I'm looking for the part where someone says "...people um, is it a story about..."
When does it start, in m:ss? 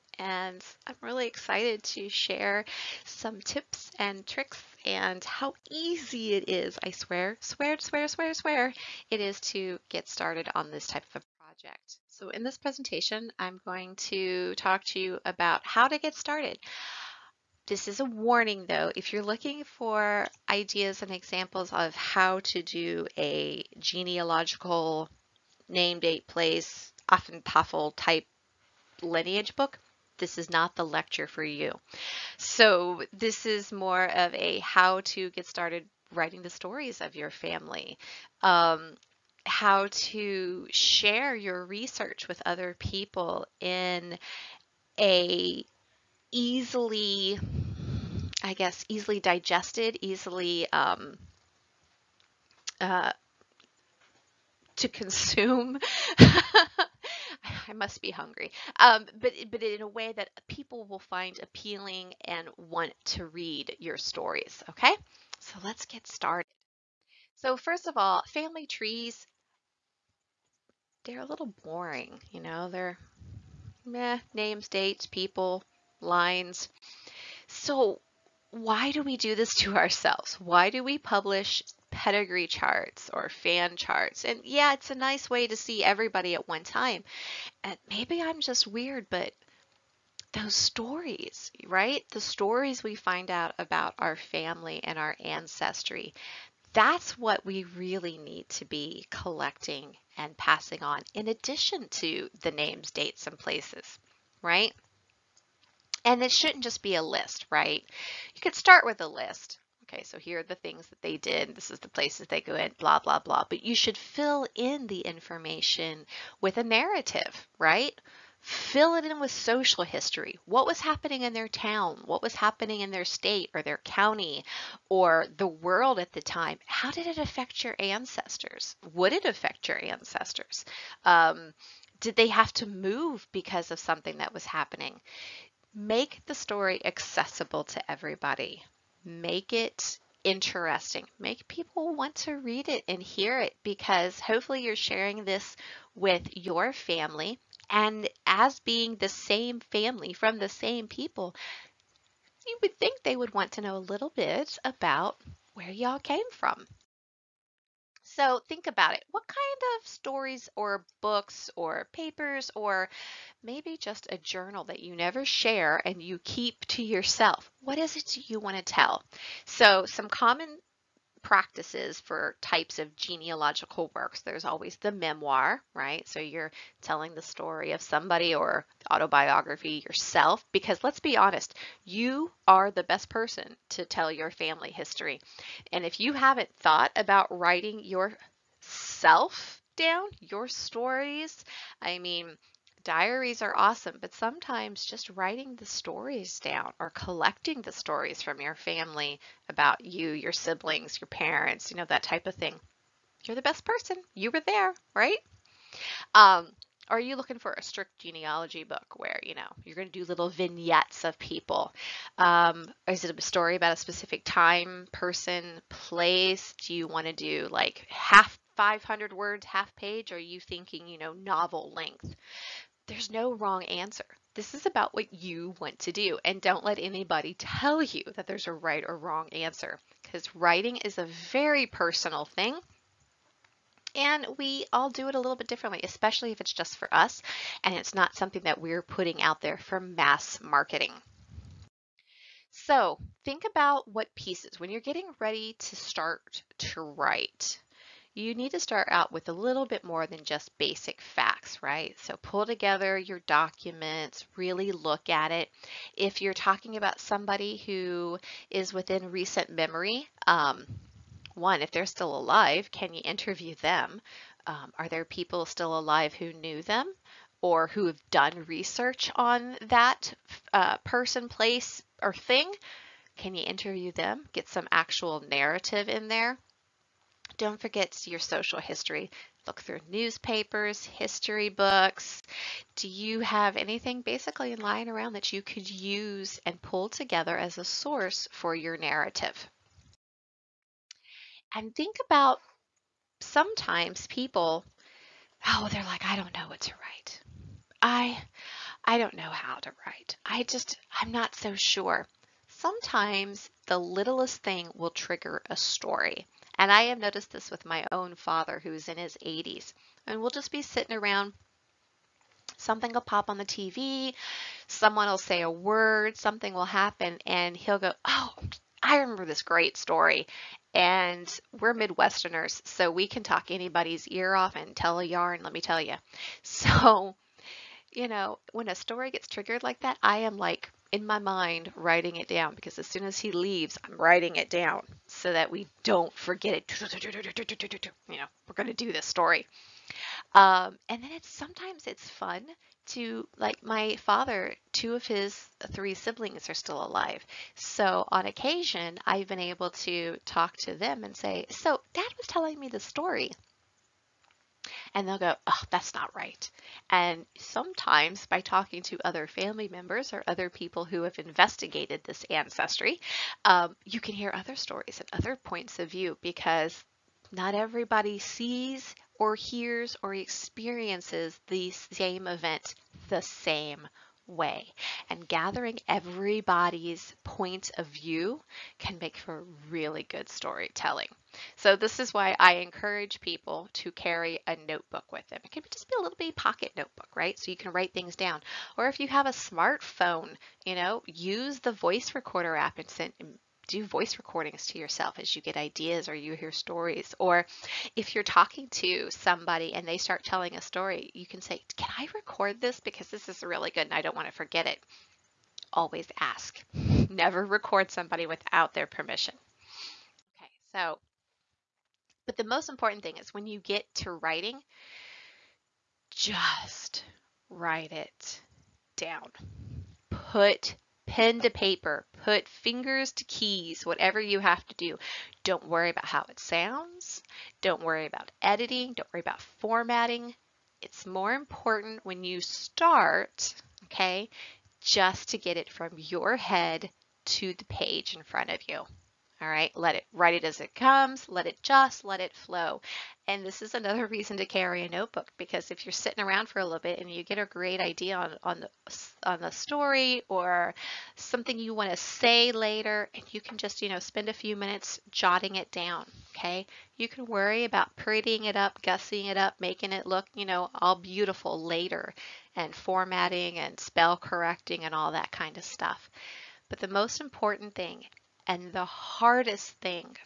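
3:31.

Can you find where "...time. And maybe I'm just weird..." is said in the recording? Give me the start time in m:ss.
1:26.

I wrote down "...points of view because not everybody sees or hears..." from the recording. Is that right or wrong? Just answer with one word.
right.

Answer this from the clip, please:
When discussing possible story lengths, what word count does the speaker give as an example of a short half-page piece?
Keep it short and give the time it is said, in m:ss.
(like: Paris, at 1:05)
500 words, at 3:38.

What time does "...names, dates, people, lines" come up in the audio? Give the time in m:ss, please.
1:14.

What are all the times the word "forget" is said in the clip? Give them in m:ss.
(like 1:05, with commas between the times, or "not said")
4:37, 5:36, 6:44.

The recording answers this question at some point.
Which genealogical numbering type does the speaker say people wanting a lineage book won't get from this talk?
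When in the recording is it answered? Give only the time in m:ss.
0:27.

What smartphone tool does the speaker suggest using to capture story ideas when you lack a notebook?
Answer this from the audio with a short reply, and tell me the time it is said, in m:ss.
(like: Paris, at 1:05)
voice recorder app, at 6:31.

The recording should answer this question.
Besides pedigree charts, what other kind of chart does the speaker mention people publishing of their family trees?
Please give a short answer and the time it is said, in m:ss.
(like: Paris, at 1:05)
fan charts, at 1:23.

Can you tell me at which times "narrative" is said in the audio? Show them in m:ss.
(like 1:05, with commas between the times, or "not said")
1:56, 4:35, 4:48.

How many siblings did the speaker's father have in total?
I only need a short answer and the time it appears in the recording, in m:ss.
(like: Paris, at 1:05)
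3, at 5:45.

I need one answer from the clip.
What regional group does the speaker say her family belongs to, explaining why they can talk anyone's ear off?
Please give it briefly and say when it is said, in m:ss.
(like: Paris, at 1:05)
Midwesterners, at 5:21.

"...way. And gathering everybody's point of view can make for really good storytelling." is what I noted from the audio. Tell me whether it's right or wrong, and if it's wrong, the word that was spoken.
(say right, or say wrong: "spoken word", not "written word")
right.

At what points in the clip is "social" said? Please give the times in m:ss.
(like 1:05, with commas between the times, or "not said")
1:59, 4:38.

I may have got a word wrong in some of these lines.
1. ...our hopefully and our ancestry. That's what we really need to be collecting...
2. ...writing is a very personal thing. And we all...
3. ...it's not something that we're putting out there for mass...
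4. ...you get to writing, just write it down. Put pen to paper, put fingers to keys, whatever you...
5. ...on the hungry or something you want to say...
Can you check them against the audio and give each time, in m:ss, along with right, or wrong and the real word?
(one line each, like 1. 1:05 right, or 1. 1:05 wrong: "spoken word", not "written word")
1. 1:33 wrong: "family", not "hopefully"
2. 3:50 right
3. 3:57 right
4. 6:53 right
5. 7:29 wrong: "story", not "hungry".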